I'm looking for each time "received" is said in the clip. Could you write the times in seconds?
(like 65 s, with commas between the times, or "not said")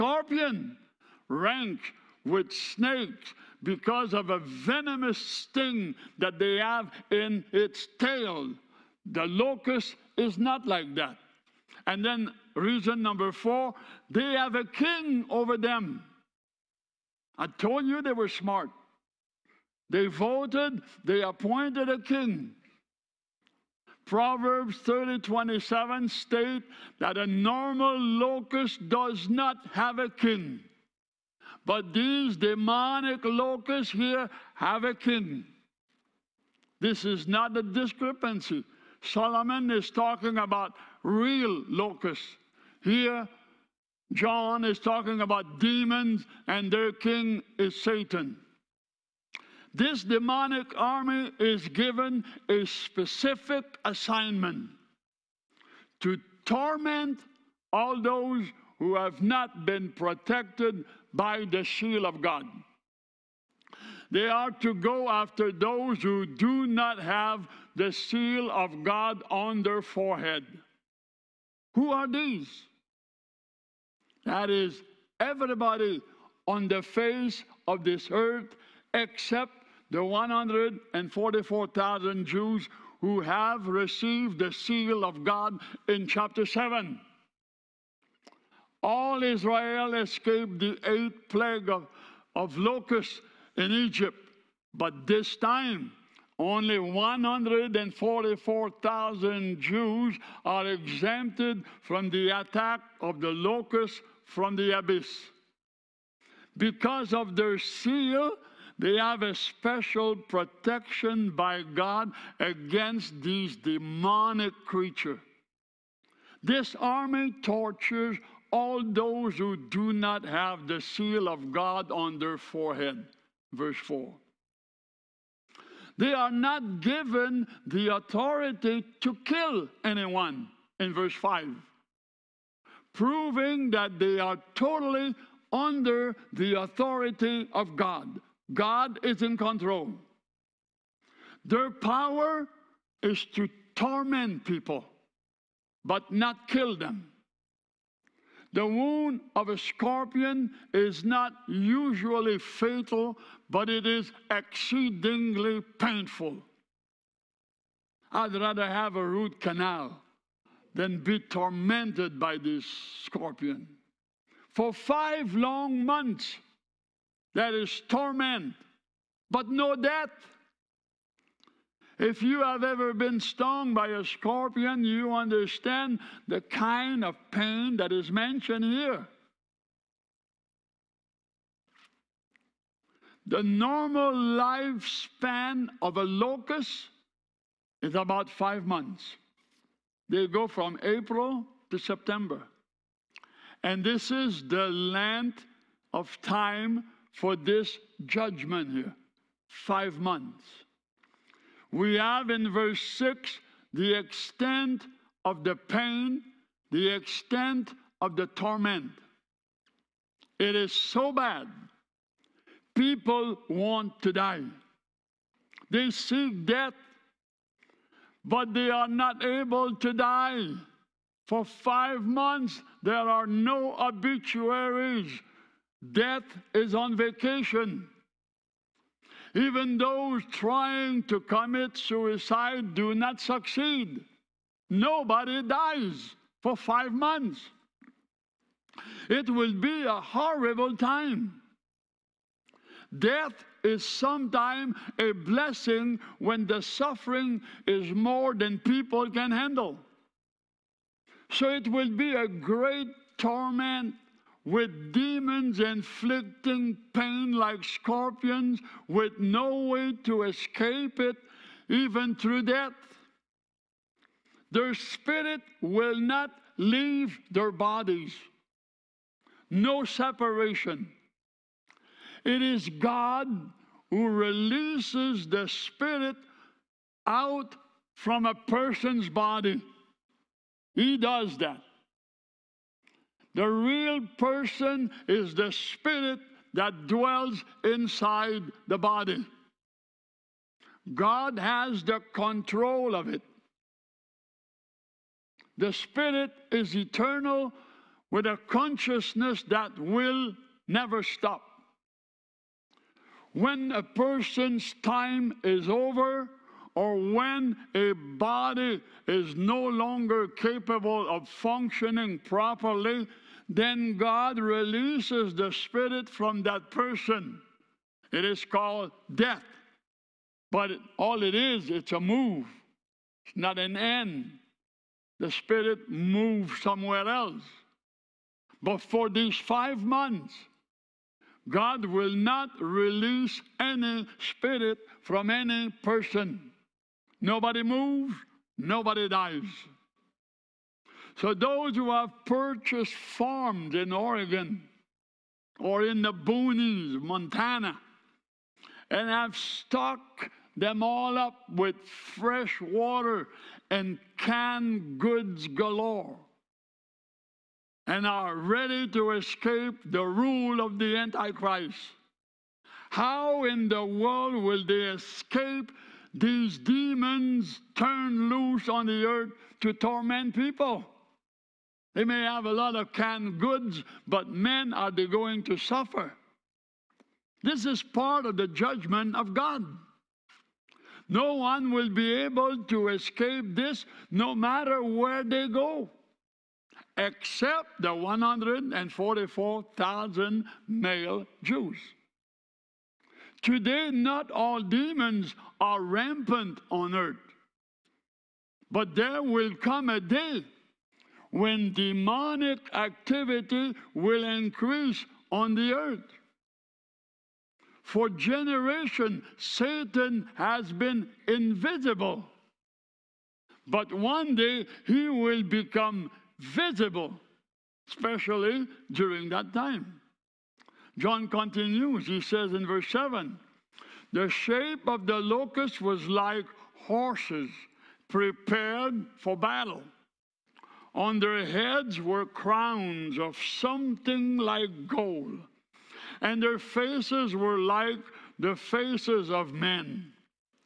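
83 s.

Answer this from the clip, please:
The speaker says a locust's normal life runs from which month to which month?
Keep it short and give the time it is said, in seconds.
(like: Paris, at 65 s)
April to September, at 190 s.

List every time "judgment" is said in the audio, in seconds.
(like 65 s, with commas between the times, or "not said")
198 s, 378 s.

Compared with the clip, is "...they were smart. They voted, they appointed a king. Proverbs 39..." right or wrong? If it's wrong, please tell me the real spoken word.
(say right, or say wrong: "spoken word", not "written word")
wrong: "30", not "39".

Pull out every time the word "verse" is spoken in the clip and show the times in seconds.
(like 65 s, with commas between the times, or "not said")
123 s, 130 s, 202 s, 422 s.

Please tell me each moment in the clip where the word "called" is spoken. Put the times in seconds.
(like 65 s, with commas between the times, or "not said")
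318 s.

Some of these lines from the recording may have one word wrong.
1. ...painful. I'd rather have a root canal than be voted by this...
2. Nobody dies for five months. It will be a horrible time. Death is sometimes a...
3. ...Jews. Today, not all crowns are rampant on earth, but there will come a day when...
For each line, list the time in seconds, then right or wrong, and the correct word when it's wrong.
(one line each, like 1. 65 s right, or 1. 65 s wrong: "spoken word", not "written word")
1. 155 s wrong: "tormented", not "voted"
2. 234 s right
3. 391 s wrong: "demons", not "crowns".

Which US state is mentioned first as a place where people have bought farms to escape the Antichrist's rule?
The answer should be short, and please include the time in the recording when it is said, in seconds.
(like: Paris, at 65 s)
Oregon, at 343 s.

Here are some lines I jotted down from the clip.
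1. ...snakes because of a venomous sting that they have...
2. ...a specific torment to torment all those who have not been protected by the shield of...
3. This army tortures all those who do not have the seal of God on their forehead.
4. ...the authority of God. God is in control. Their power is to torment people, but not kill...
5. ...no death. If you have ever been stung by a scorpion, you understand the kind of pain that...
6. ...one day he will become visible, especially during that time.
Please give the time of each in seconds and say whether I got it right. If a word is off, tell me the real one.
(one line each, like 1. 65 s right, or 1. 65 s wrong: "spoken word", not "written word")
1. 2 s right
2. 52 s wrong: "assignment", not "torment"
3. 116 s right
4. 136 s right
5. 169 s right
6. 413 s right.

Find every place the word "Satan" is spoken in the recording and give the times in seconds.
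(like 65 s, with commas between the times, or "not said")
47 s, 409 s.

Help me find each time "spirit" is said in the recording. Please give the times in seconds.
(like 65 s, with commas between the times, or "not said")
264 s, 275 s, 285 s, 295 s, 315 s, 325 s, 334 s.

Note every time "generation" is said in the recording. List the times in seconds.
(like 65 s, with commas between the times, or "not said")
408 s.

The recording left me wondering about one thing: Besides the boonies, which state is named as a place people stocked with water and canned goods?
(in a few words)
Montana.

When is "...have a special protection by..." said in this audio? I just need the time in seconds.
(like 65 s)
108 s.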